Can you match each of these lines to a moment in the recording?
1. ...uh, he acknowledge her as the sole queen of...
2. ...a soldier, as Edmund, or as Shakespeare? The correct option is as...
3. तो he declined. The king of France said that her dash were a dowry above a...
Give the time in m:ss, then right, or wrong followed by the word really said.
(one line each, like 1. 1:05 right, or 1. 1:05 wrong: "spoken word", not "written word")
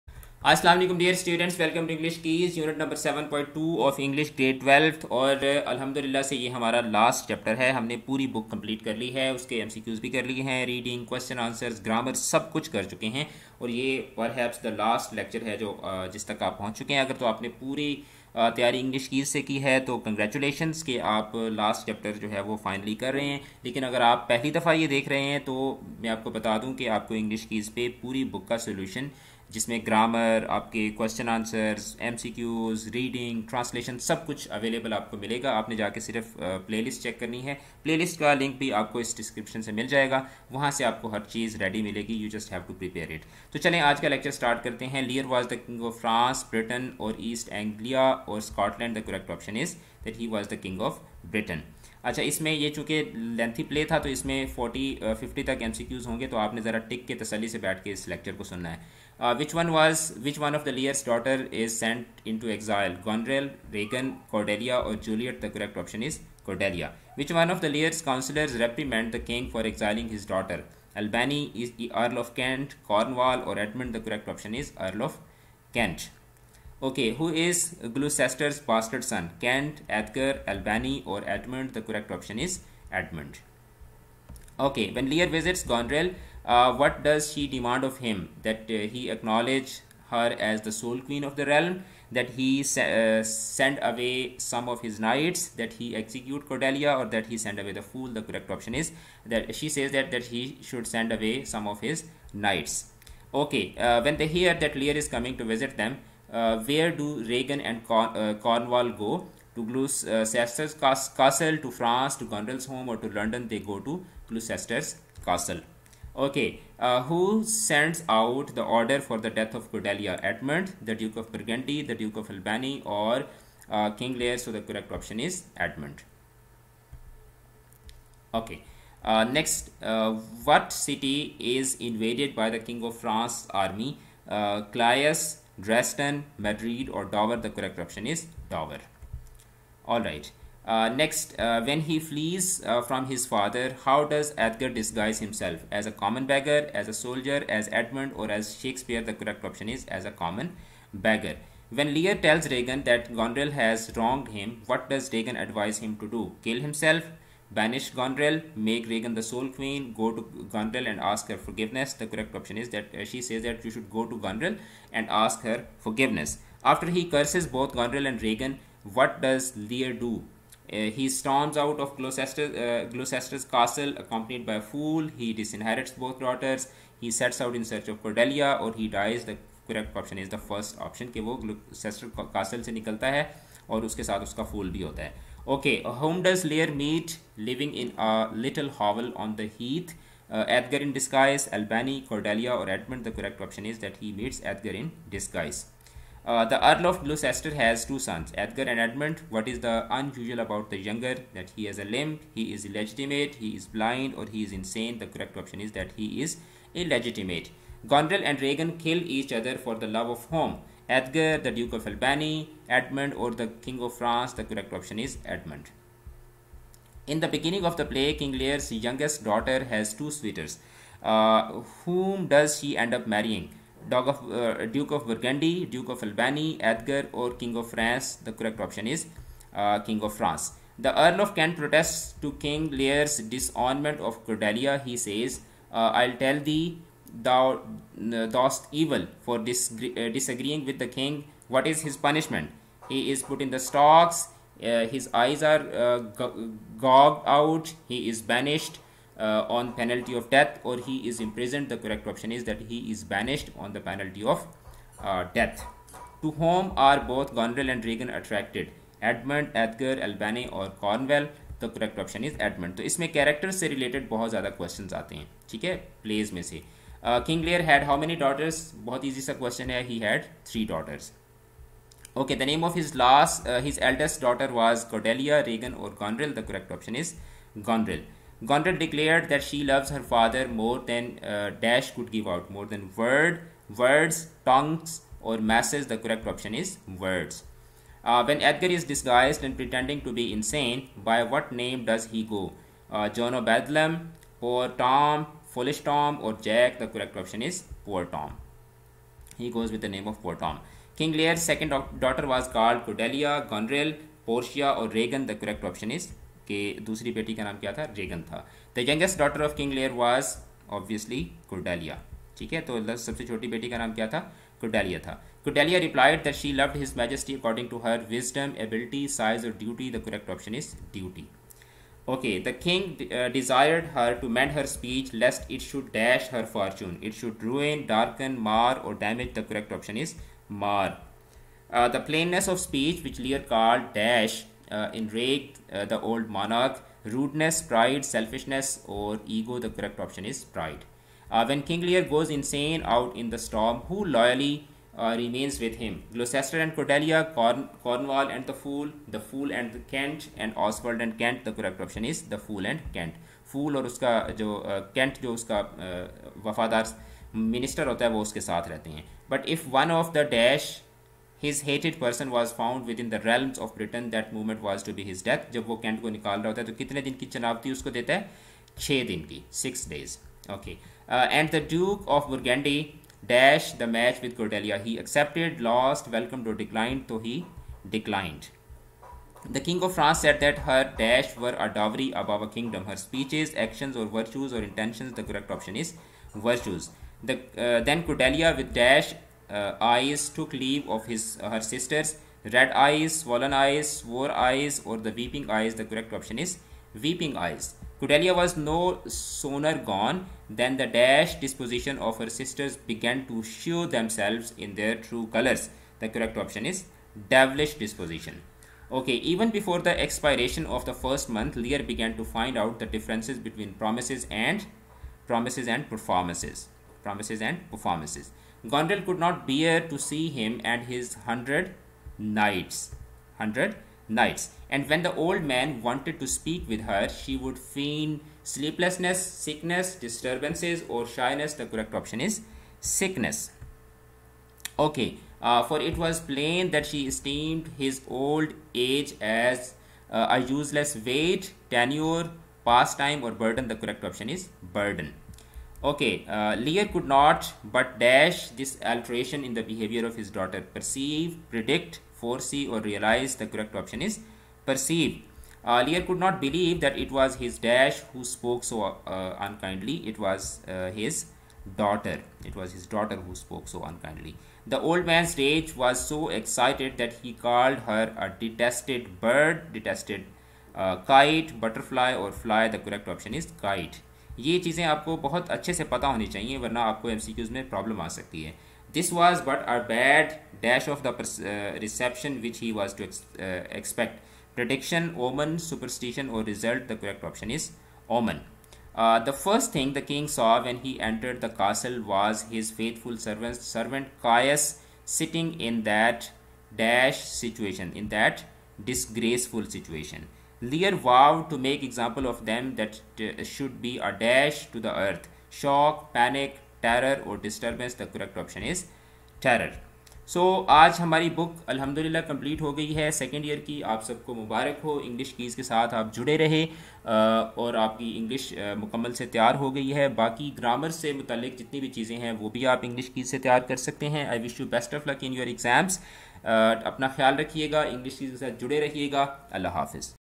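1. 1:28 right
2. 2:26 right
3. 6:17 right.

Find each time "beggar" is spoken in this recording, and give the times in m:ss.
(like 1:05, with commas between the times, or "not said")
2:26, 2:30.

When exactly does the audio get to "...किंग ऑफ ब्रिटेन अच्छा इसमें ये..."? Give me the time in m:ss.
0:50.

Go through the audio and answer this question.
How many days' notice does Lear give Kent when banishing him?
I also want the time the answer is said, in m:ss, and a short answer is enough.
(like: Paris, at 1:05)
6, at 6:08.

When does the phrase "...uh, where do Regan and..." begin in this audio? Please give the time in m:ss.
1:46.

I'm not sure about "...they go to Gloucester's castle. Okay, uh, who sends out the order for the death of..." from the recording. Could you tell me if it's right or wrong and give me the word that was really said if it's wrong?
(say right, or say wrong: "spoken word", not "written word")
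right.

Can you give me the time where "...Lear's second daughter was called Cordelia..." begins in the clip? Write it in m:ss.
5:01.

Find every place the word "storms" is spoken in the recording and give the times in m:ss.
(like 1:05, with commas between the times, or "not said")
2:51, 5:43.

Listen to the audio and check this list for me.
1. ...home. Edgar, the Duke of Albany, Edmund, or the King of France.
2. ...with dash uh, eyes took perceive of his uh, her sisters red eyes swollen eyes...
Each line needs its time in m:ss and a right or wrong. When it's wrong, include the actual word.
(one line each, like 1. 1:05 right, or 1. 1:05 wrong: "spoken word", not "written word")
1. 3:30 right
2. 6:28 wrong: "leave", not "perceive".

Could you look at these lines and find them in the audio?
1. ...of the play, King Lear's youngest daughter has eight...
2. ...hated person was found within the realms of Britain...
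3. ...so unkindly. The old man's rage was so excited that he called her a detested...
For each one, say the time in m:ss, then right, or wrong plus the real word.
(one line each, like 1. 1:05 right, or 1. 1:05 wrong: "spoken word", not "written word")
1. 3:37 wrong: "two", not "eight"
2. 6:01 right
3. 7:43 right.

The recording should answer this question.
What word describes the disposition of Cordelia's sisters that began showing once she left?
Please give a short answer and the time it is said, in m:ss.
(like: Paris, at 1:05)
Devilish, at 6:47.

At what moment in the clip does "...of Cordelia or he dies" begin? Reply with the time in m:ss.
2:57.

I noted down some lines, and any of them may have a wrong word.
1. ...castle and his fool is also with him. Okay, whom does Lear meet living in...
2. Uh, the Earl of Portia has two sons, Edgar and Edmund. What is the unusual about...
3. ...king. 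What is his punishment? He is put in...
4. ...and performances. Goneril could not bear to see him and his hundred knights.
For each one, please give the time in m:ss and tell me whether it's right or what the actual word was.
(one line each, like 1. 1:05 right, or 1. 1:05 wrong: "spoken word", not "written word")
1. 3:02 right
2. 3:16 wrong: "Gloucester", not "Portia"
3. 4:00 right
4. 6:57 right.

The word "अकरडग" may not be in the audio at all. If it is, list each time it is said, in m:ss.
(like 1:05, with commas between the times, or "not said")
5:17.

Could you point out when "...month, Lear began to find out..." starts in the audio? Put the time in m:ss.
6:51.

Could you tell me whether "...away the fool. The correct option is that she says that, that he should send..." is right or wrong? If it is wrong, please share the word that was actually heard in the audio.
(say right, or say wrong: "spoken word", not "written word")
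right.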